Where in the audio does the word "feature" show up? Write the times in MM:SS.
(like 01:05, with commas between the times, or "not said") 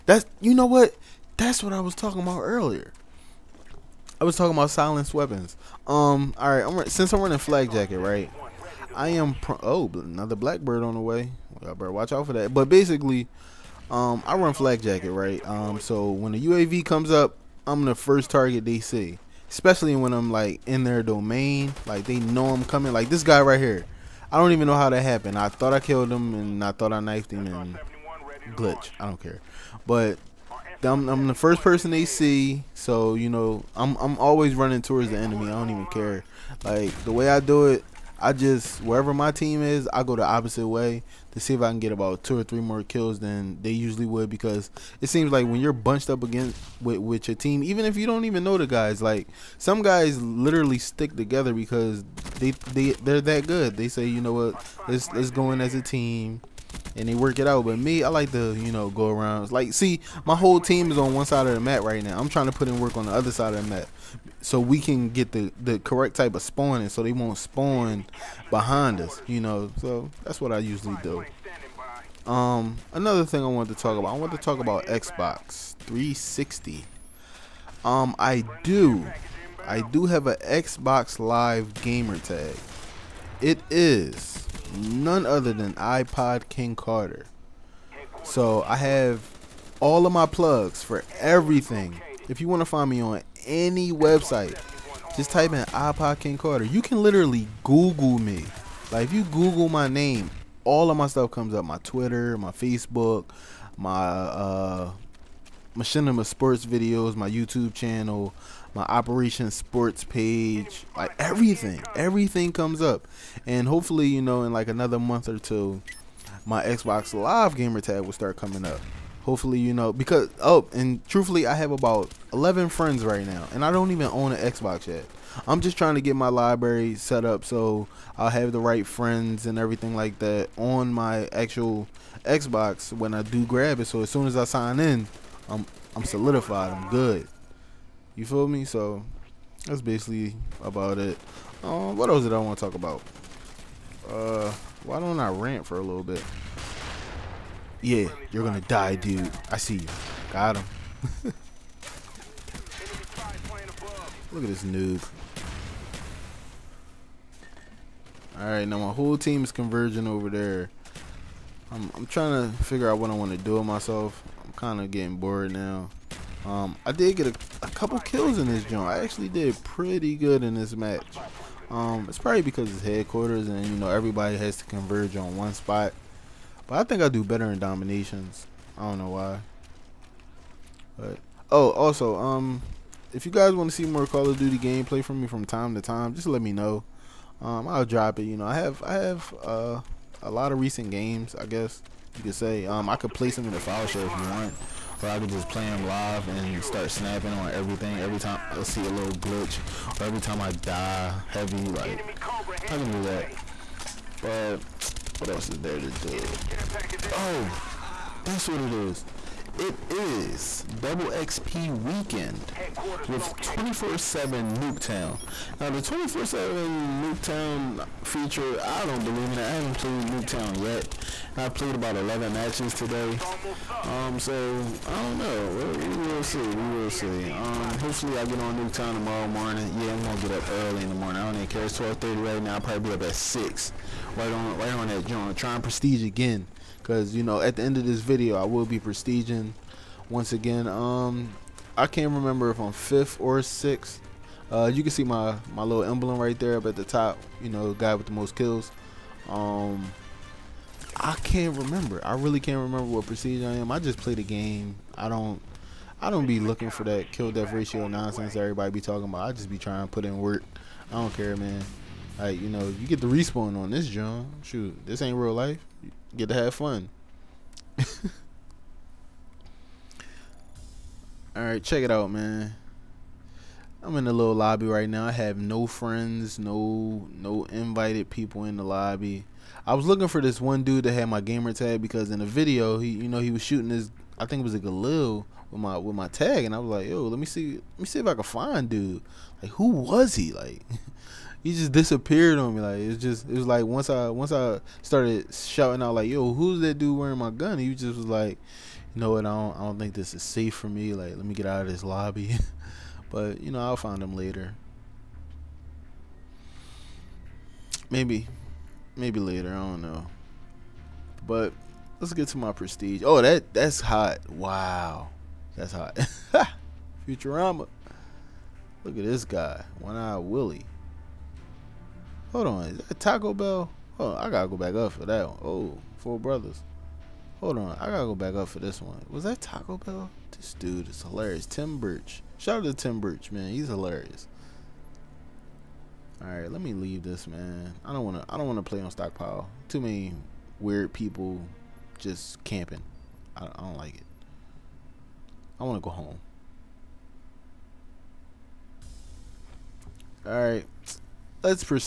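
03:38.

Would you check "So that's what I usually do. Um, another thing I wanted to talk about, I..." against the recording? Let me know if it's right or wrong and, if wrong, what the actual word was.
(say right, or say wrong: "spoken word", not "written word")
right.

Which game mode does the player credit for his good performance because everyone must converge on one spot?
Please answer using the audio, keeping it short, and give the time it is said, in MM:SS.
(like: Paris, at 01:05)
Headquarters, at 02:52.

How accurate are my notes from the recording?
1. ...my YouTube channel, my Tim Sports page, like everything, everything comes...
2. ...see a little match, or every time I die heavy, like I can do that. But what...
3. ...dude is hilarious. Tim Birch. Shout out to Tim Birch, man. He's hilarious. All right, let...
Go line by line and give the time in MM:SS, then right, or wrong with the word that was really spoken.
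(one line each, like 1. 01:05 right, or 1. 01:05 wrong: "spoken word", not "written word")
1. 01:47 wrong: "Operation", not "Tim"
2. 03:18 wrong: "glitch", not "match"
3. 05:30 right.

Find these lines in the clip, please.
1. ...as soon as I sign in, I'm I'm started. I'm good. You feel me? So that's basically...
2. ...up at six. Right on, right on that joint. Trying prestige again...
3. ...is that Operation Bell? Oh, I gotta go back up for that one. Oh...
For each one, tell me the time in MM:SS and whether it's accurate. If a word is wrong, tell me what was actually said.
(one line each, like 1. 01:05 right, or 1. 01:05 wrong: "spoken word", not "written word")
1. 02:13 wrong: "solidified", not "started"
2. 03:52 right
3. 05:22 wrong: "Taco", not "Operation".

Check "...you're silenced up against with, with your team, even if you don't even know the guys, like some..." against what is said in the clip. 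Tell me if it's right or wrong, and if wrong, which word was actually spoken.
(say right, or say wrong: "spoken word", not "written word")
wrong: "bunched", not "silenced".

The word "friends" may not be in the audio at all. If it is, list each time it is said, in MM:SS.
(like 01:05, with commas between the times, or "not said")
02:02, 02:08, 04:35.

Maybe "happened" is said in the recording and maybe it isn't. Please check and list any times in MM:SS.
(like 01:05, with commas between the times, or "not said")
00:25.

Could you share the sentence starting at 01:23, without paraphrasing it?
It is none other than iPod King Carter.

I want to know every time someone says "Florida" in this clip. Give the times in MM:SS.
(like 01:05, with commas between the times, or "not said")
not said.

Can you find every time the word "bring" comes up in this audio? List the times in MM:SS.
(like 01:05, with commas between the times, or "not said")
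not said.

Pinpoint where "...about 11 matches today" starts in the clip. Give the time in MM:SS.
03:41.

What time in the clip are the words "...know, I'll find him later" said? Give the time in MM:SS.
05:03.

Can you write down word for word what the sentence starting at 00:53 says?
They say, you know what, let's let's go in as a team and they work it out.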